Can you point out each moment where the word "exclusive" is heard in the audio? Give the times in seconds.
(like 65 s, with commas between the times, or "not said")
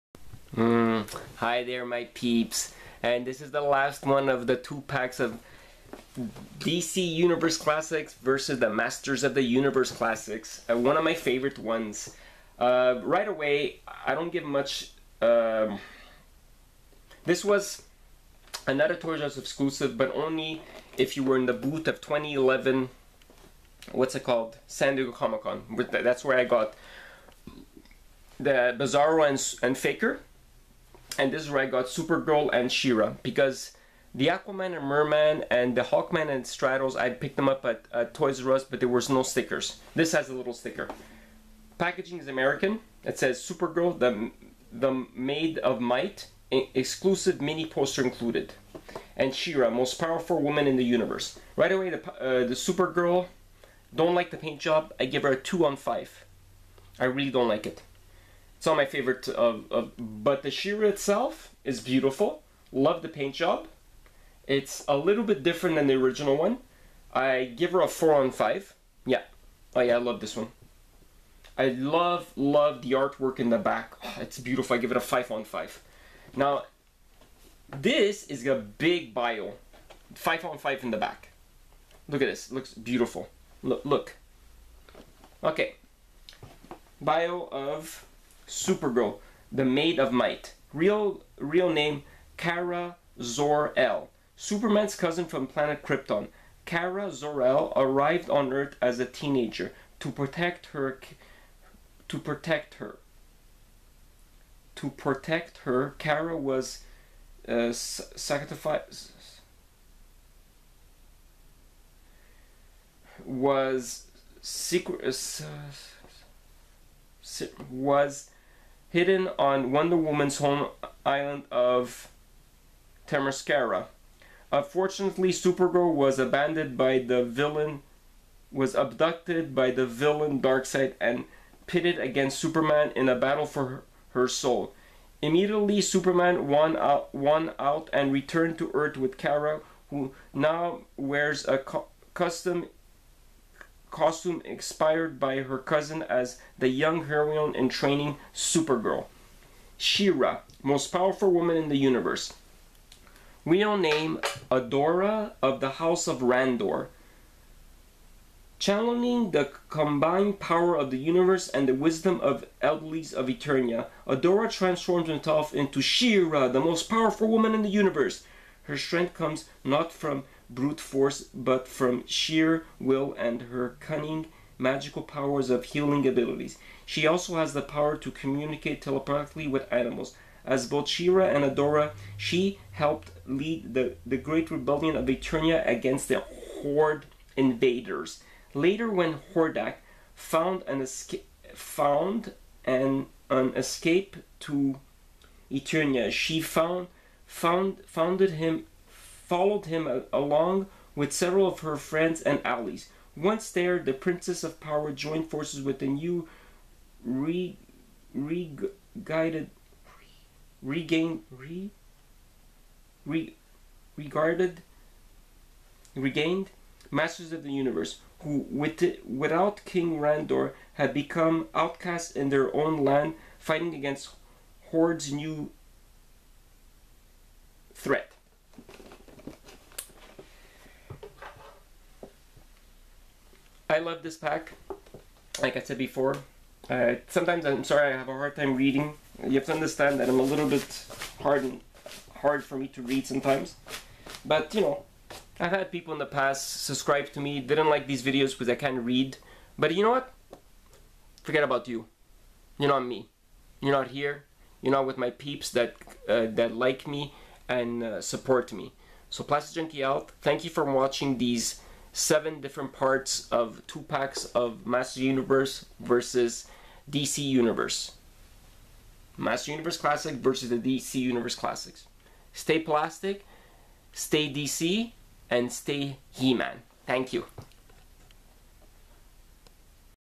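19 s, 46 s.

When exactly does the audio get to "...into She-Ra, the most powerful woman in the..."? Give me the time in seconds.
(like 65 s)
165 s.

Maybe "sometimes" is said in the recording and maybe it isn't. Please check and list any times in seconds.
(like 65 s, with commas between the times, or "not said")
237 s, 243 s.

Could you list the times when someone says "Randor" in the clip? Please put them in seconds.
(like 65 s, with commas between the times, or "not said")
156 s, 219 s.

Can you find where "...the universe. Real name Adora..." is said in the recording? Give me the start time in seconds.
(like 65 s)
151 s.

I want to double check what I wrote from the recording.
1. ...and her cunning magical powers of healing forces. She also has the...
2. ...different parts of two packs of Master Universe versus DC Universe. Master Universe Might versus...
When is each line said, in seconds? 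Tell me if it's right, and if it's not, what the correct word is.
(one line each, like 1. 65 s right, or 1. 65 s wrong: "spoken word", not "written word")
1. 173 s wrong: "abilities", not "forces"
2. 262 s wrong: "Classic", not "Might".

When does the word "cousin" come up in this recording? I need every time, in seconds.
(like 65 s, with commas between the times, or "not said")
94 s, 145 s.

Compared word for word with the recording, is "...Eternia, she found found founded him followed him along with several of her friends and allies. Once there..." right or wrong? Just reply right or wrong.
right.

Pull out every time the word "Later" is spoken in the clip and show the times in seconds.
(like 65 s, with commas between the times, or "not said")
188 s.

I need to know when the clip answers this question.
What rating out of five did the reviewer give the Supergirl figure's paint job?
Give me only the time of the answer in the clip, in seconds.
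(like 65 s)
55 s.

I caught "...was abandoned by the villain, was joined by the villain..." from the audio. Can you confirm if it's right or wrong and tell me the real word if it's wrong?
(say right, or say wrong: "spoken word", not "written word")
wrong: "abducted", not "joined".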